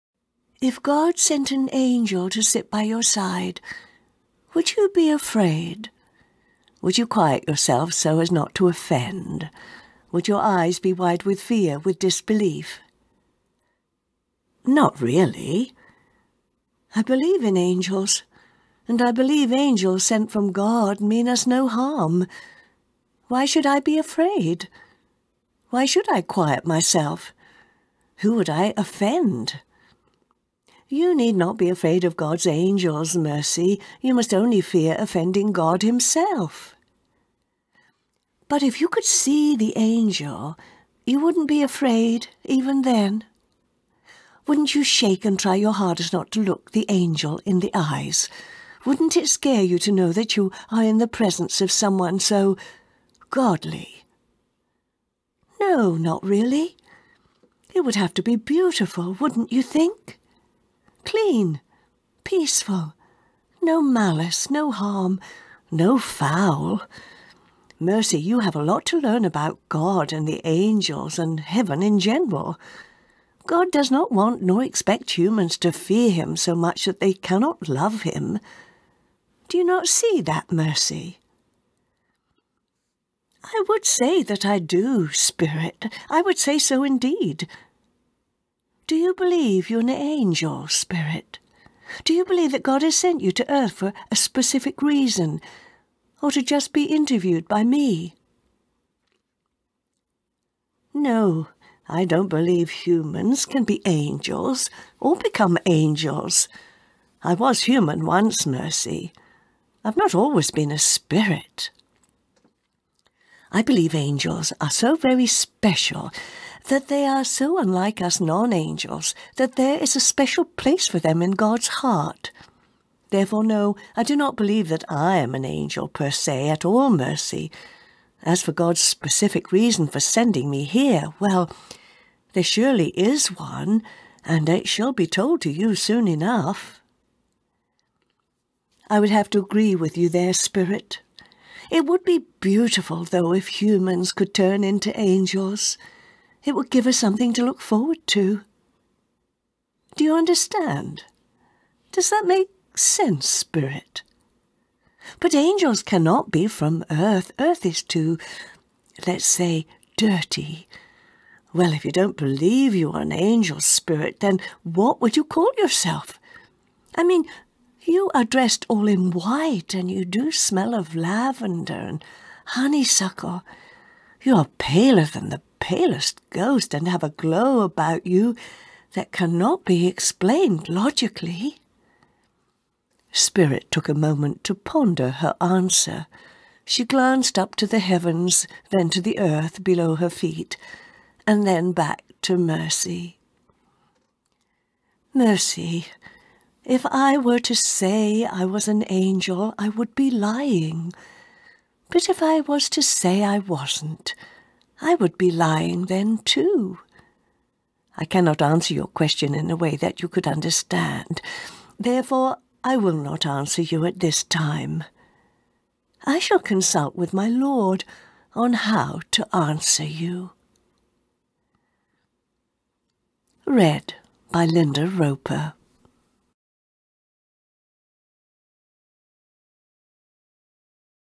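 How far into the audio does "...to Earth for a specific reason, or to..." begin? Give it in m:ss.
1:33.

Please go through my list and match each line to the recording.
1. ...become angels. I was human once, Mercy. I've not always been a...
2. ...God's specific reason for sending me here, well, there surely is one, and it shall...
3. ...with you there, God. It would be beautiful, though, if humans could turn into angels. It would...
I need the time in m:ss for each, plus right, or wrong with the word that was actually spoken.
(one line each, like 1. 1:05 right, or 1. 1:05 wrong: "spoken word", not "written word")
1. 1:45 right
2. 2:08 right
3. 2:19 wrong: "Spirit", not "God".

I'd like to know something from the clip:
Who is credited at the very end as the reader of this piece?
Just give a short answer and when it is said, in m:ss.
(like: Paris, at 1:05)
Linda Roper, at 3:44.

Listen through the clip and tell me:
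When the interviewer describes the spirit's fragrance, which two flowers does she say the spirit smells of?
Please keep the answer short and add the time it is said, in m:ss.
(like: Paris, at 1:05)
lavender and honeysuckle, at 2:50.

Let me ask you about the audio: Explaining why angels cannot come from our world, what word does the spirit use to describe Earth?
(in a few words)
dirty.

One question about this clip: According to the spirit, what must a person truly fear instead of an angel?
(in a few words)
offending God himself.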